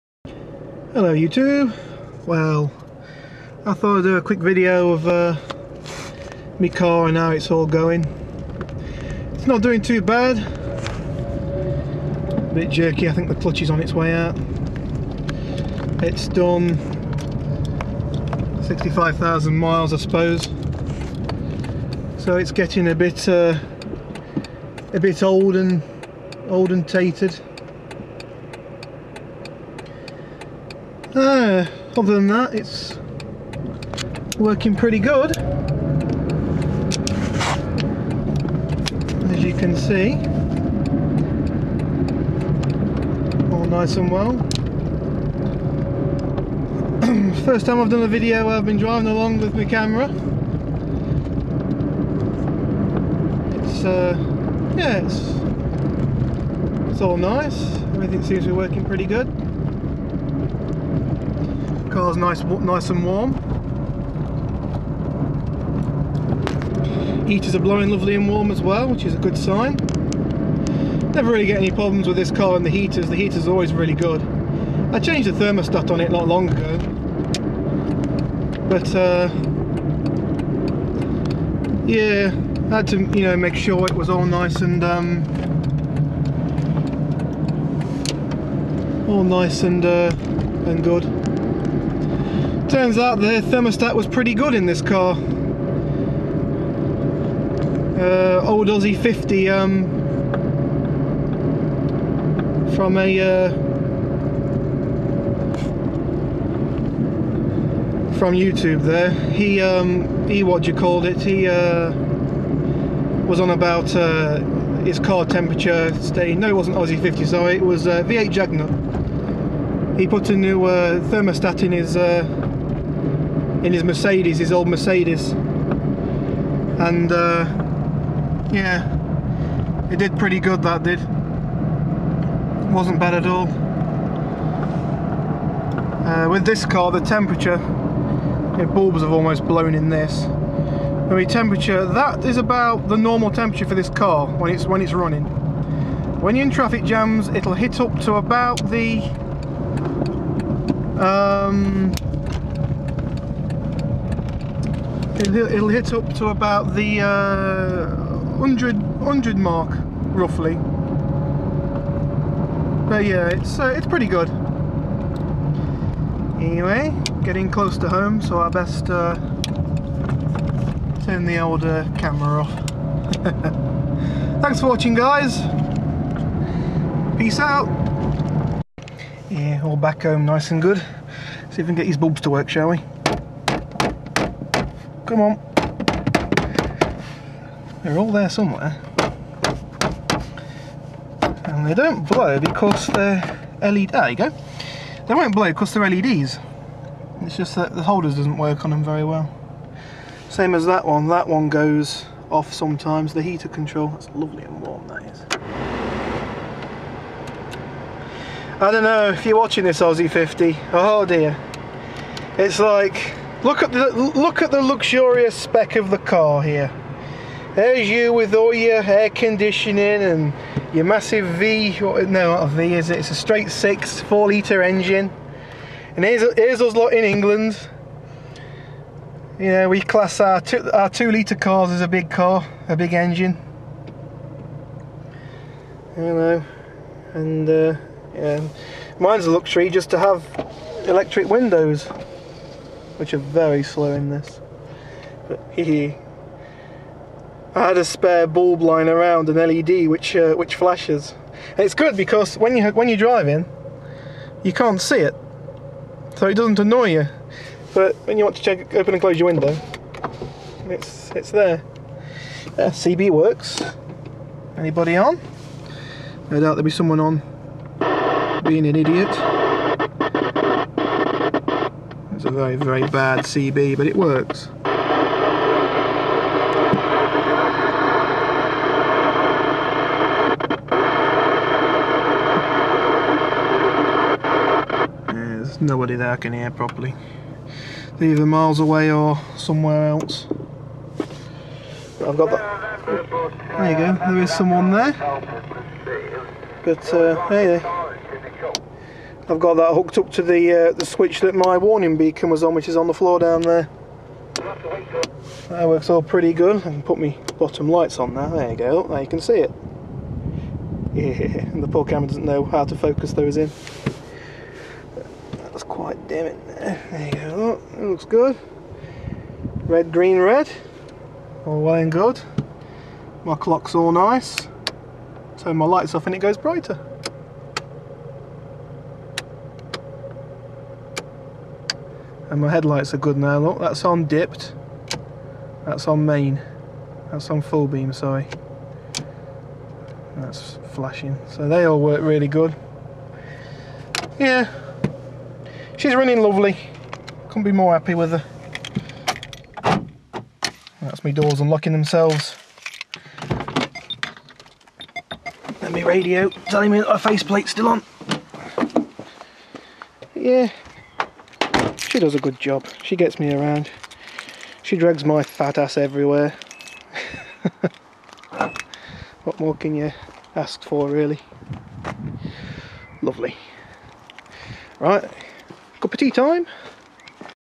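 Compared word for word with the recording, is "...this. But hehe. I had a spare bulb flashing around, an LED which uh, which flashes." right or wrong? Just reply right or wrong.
wrong.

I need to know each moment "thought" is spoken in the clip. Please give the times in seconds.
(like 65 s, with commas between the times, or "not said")
3 s.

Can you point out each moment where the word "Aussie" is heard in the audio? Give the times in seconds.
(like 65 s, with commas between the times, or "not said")
98 s, 116 s, 209 s.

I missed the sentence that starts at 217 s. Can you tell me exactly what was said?
There's you with all your air conditioning and your massive V.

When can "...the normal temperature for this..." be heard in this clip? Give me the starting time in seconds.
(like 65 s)
142 s.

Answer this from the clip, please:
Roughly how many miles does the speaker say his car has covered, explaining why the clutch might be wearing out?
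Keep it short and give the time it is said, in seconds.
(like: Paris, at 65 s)
65,000, at 18 s.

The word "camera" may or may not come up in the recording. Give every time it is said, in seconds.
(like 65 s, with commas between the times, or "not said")
49 s, 171 s, 311 s.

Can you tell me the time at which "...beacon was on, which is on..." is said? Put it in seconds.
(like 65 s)
301 s.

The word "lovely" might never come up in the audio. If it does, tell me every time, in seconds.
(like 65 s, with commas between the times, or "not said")
67 s, 204 s, 346 s, 373 s.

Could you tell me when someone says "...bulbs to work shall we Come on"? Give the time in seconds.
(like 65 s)
181 s.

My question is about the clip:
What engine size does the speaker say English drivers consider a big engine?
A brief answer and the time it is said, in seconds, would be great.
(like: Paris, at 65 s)
2 litre, at 230 s.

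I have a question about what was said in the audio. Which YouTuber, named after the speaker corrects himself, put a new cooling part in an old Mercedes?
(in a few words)
V8 Jagna.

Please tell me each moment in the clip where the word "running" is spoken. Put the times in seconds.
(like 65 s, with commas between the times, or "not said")
144 s, 345 s.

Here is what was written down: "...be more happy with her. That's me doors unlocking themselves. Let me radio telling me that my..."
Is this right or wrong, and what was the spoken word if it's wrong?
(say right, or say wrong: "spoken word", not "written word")
right.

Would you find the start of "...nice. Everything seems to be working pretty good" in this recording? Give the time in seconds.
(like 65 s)
57 s.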